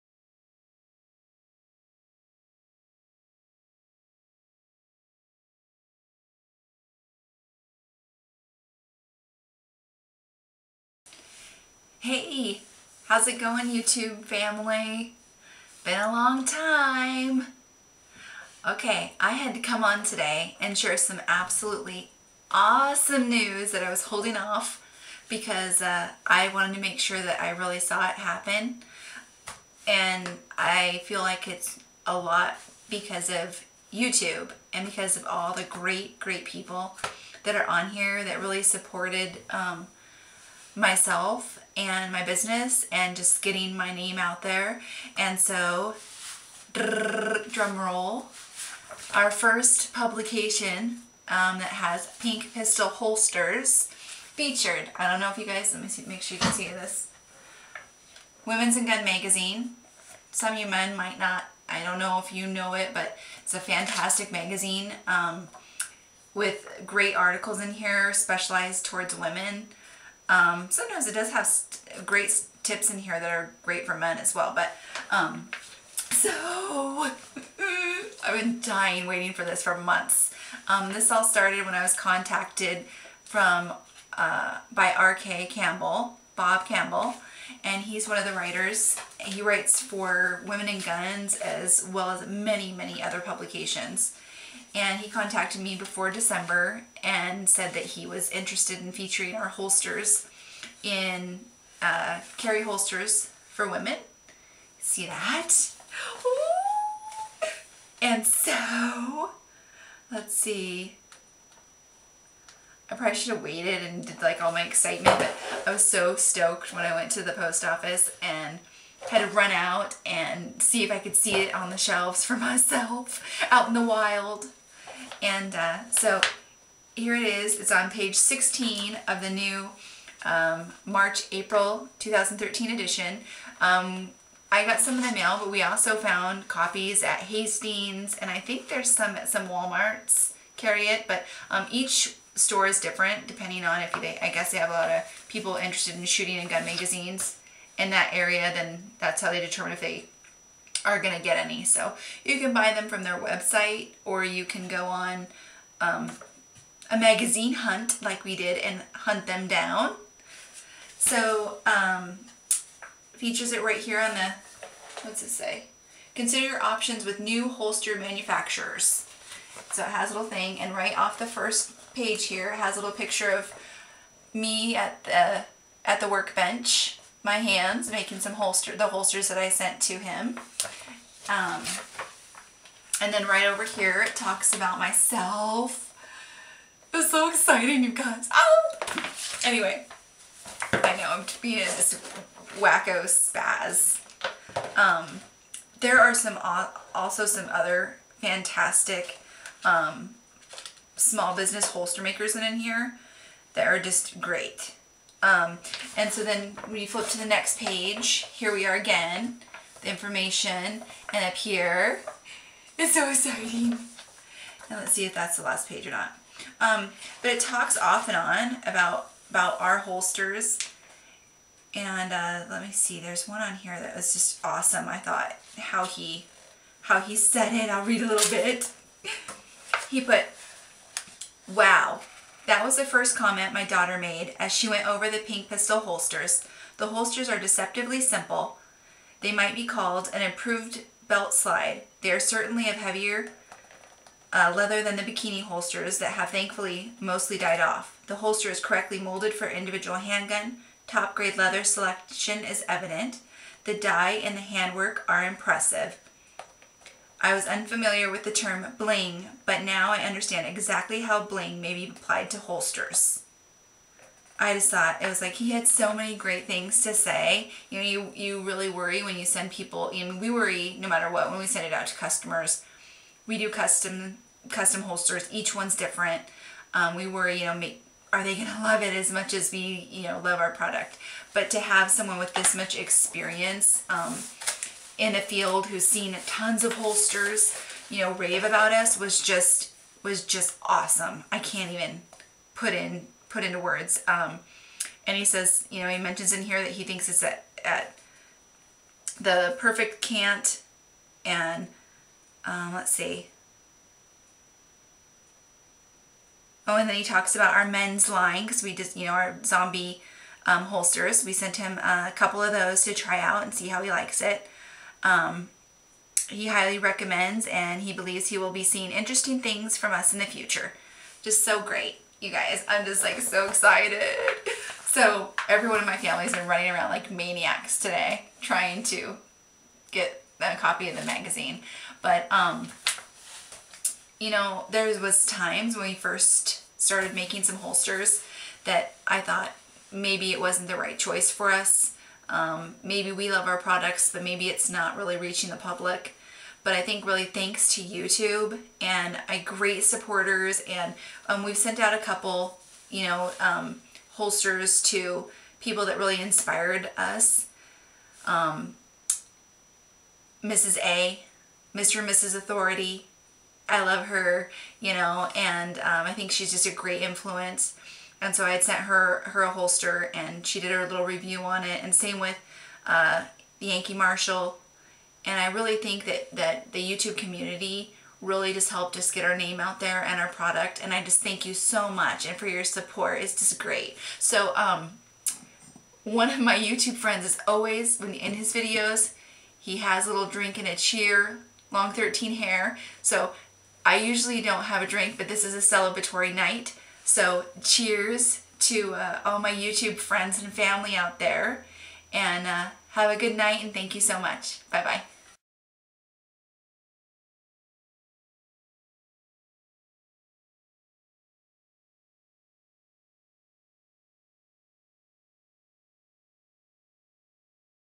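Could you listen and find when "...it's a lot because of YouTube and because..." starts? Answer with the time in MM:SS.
00:31.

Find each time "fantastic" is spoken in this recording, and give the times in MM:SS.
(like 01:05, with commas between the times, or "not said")
01:03, 03:18.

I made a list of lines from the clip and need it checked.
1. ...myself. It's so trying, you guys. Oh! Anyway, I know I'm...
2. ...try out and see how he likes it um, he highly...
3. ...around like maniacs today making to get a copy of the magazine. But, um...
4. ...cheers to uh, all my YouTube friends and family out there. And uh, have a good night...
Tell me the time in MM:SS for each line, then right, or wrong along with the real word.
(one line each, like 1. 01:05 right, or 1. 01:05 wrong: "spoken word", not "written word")
1. 03:04 wrong: "exciting", not "trying"
2. 05:12 right
3. 05:26 wrong: "trying", not "making"
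4. 06:37 right.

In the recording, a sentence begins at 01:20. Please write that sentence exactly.
Um, this all started when I was contacted from uh, by R.K.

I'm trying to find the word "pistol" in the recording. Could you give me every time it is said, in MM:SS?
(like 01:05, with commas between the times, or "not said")
00:52, 03:55.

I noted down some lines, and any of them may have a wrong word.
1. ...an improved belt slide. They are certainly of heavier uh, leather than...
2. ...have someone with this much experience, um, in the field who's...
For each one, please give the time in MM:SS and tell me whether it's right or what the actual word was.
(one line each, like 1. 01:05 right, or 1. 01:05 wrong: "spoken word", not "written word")
1. 04:00 right
2. 04:41 right.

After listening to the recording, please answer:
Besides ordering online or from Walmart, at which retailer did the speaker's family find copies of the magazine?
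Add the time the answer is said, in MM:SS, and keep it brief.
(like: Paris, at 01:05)
Hastings, at 02:17.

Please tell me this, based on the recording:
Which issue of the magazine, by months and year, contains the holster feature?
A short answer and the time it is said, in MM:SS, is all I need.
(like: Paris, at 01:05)
March-April 2013, at 02:10.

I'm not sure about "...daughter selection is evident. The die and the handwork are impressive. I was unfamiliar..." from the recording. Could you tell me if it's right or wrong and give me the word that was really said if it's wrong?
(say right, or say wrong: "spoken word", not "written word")
wrong: "leather", not "daughter".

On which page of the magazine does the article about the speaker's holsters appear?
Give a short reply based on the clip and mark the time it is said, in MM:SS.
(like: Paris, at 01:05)
16, at 02:07.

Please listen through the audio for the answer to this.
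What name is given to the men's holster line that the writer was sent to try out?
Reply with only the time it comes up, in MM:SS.
05:09.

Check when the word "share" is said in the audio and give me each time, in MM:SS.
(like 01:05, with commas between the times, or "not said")
00:20.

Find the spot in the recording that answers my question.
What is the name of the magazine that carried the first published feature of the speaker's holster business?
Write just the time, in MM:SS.
00:58.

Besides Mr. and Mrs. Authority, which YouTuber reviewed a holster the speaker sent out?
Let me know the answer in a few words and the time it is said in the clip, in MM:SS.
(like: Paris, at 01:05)
Yankee Marshal, at 06:13.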